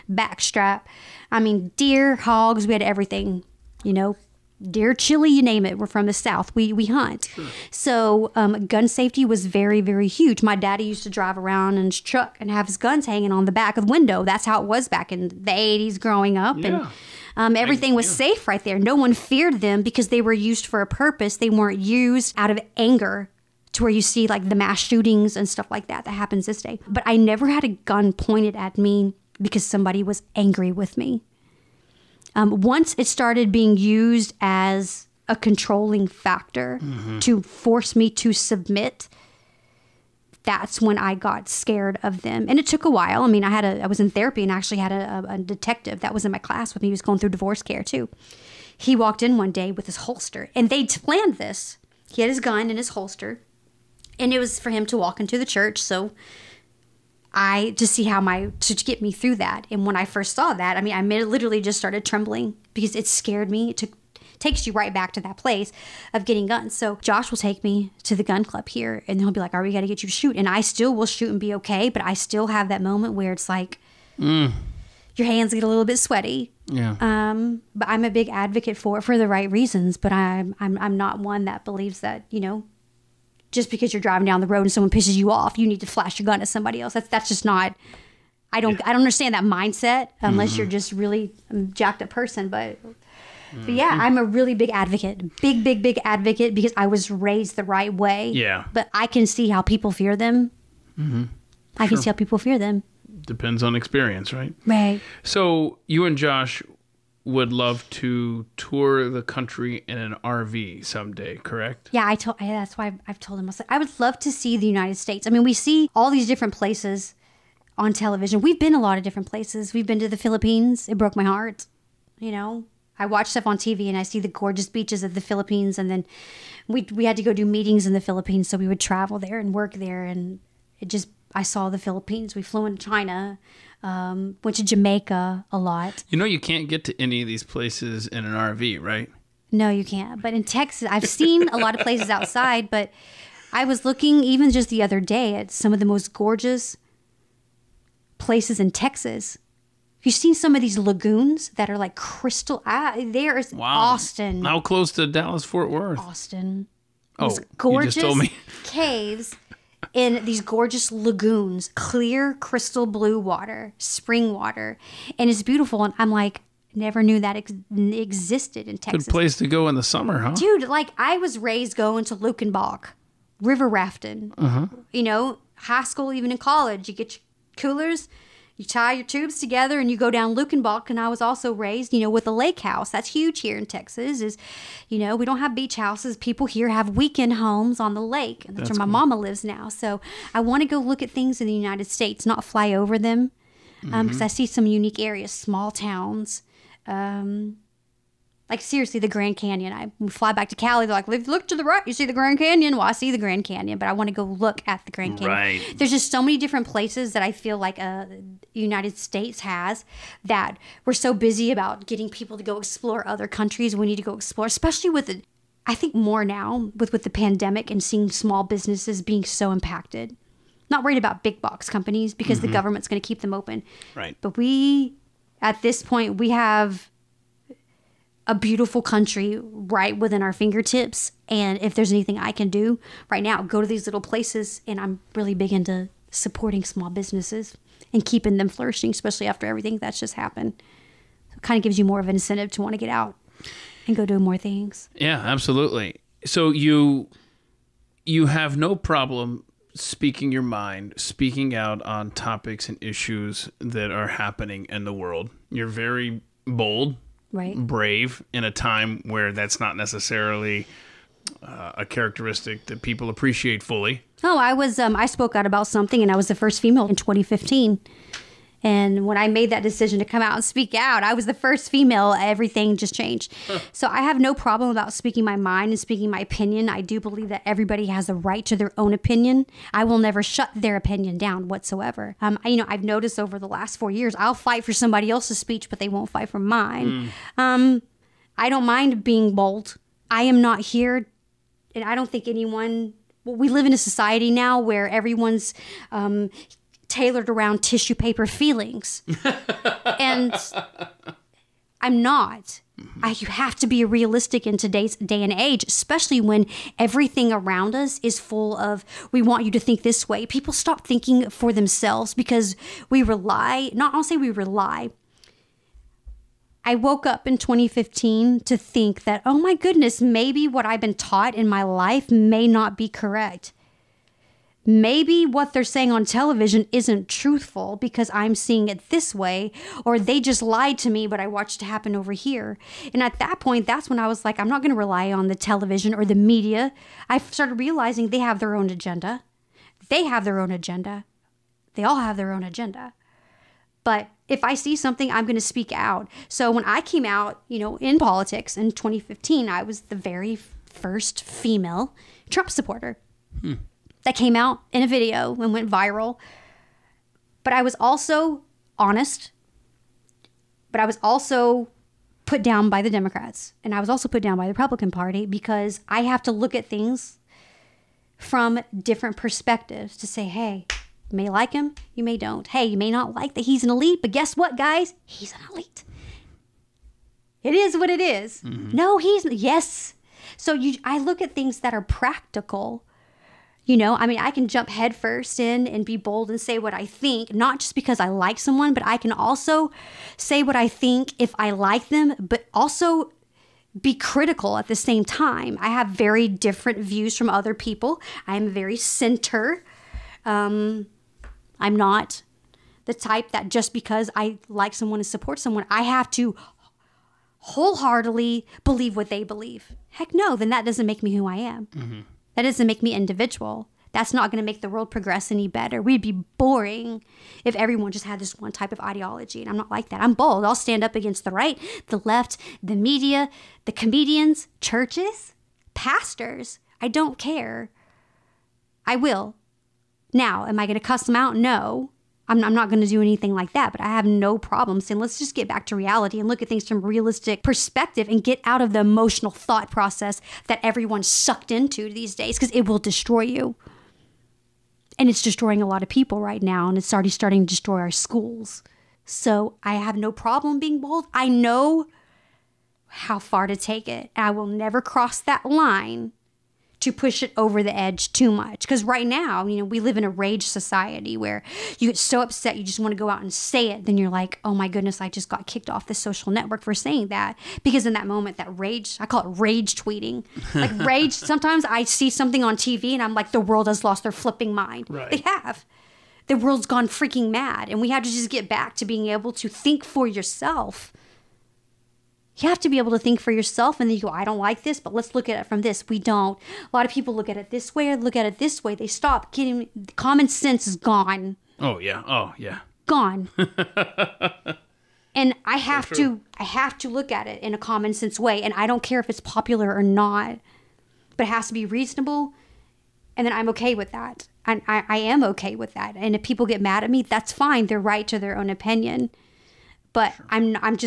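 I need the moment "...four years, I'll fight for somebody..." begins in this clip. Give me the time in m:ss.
4:43.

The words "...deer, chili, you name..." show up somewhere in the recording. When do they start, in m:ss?
0:04.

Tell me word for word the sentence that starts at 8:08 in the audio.
They stop getting common sense is gone.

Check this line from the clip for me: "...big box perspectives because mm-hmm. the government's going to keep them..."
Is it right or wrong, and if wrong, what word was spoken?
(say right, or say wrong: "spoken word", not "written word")
wrong: "companies", not "perspectives".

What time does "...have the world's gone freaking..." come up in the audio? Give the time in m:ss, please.
7:55.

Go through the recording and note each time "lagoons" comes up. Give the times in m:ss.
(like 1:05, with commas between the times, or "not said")
2:30, 2:40.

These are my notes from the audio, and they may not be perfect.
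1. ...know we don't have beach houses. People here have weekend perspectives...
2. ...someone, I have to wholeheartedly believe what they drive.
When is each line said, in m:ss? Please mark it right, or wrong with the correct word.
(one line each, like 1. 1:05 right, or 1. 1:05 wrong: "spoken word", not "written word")
1. 3:04 wrong: "homes", not "perspectives"
2. 6:45 wrong: "believe", not "drive".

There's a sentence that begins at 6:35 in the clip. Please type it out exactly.
I have very different views from other people.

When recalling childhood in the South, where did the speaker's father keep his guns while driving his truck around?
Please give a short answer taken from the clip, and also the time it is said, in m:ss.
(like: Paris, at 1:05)
back of the window, at 0:13.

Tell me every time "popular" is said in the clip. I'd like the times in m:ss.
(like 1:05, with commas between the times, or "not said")
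8:19.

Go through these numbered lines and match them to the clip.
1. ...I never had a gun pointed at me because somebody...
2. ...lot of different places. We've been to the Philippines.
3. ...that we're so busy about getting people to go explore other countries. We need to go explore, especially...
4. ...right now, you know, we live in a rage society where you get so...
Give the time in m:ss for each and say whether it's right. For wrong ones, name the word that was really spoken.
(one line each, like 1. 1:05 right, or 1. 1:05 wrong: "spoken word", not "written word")
1. 0:27 right
2. 1:58 right
3. 3:30 right
4. 7:38 right.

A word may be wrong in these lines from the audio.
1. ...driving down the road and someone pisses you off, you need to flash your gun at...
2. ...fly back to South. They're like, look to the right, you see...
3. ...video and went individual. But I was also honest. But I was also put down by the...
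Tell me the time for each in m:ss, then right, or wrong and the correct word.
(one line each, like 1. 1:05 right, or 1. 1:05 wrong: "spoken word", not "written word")
1. 1:24 right
2. 3:20 wrong: "Cali", not "South"
3. 5:54 wrong: "viral", not "individual".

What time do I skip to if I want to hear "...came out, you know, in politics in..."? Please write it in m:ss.
5:46.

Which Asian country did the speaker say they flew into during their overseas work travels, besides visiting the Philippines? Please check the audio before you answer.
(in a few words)
China.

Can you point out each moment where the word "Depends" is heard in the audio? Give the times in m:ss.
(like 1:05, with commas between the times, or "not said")
1:43.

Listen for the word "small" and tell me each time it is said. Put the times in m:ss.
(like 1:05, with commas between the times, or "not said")
3:15, 3:38, 3:56.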